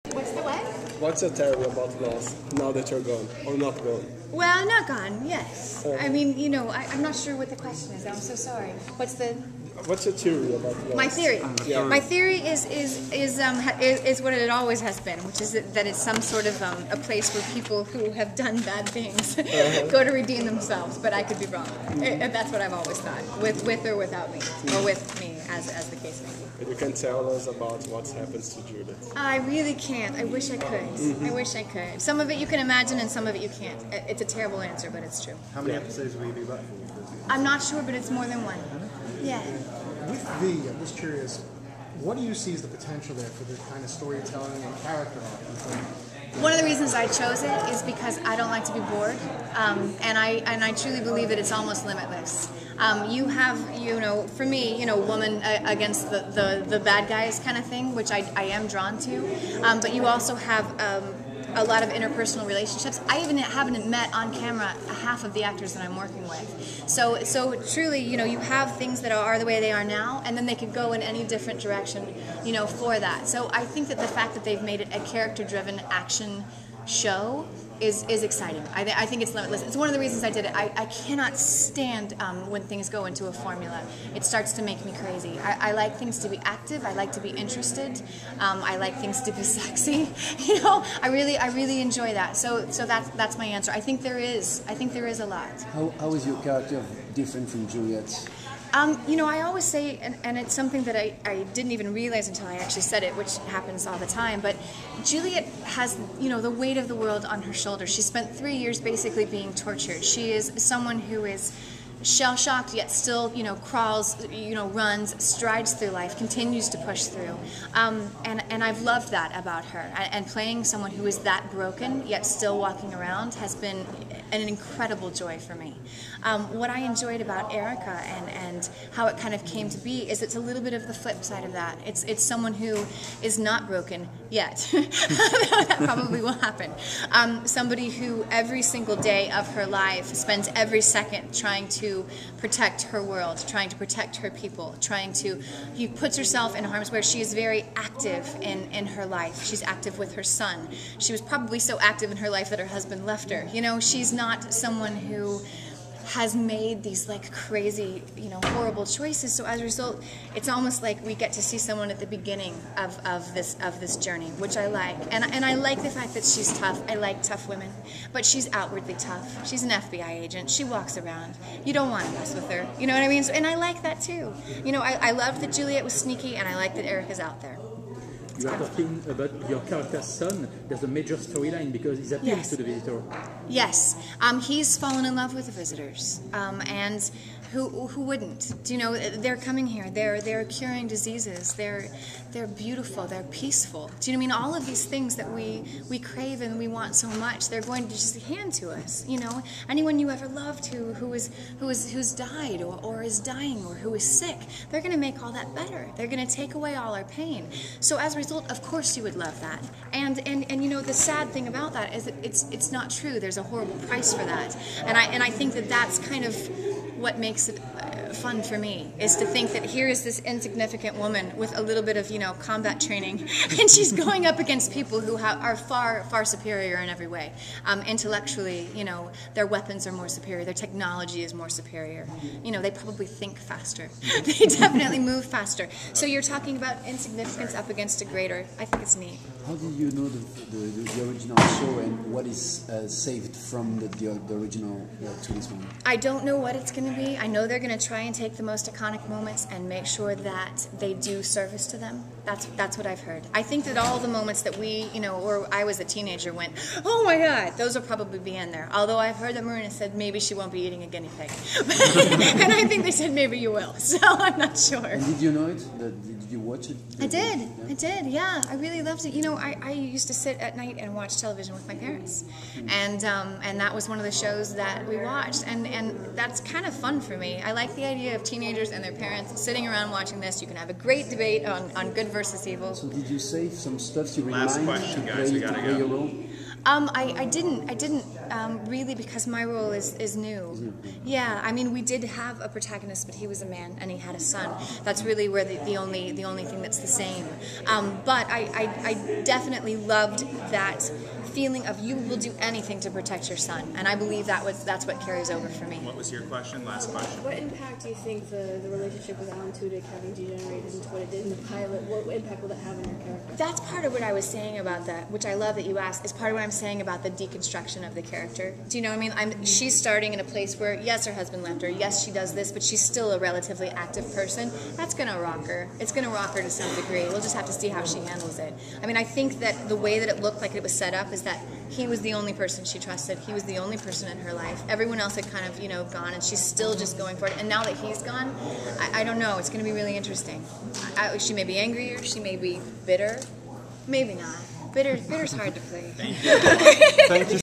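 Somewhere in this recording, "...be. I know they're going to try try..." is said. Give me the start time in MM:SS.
04:06.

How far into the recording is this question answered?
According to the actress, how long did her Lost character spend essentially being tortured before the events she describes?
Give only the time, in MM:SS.
01:48.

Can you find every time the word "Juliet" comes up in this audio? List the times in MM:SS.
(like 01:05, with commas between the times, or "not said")
00:28, 01:37, 01:45, 02:55.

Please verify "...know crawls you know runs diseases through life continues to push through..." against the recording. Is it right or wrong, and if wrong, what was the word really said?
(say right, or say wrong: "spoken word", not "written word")
wrong: "strides", not "diseases".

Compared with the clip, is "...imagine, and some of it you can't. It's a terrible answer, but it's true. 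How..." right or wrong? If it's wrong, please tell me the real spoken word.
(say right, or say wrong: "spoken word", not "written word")
right.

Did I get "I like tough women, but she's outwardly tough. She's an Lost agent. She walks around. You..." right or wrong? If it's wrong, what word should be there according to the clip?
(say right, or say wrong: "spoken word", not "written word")
wrong: "FBI", not "Lost".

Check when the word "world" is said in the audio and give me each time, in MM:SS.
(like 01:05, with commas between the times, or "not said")
01:46, 02:23.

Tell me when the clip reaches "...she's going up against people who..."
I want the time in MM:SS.
03:43.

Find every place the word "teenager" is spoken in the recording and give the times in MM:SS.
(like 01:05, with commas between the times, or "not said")
04:15, 04:38.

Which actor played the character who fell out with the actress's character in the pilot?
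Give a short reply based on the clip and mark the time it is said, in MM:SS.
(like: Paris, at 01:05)
Alan Tudyk, at 05:09.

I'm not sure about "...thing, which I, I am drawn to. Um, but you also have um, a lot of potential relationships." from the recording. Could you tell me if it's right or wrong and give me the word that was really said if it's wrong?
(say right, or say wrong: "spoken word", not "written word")
wrong: "interpersonal", not "potential".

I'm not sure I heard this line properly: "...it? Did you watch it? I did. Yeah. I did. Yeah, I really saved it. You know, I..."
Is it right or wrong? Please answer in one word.
wrong.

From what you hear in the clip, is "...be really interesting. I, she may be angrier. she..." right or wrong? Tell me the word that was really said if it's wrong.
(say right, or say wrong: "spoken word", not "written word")
right.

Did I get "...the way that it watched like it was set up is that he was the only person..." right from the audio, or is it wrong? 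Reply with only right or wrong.
wrong.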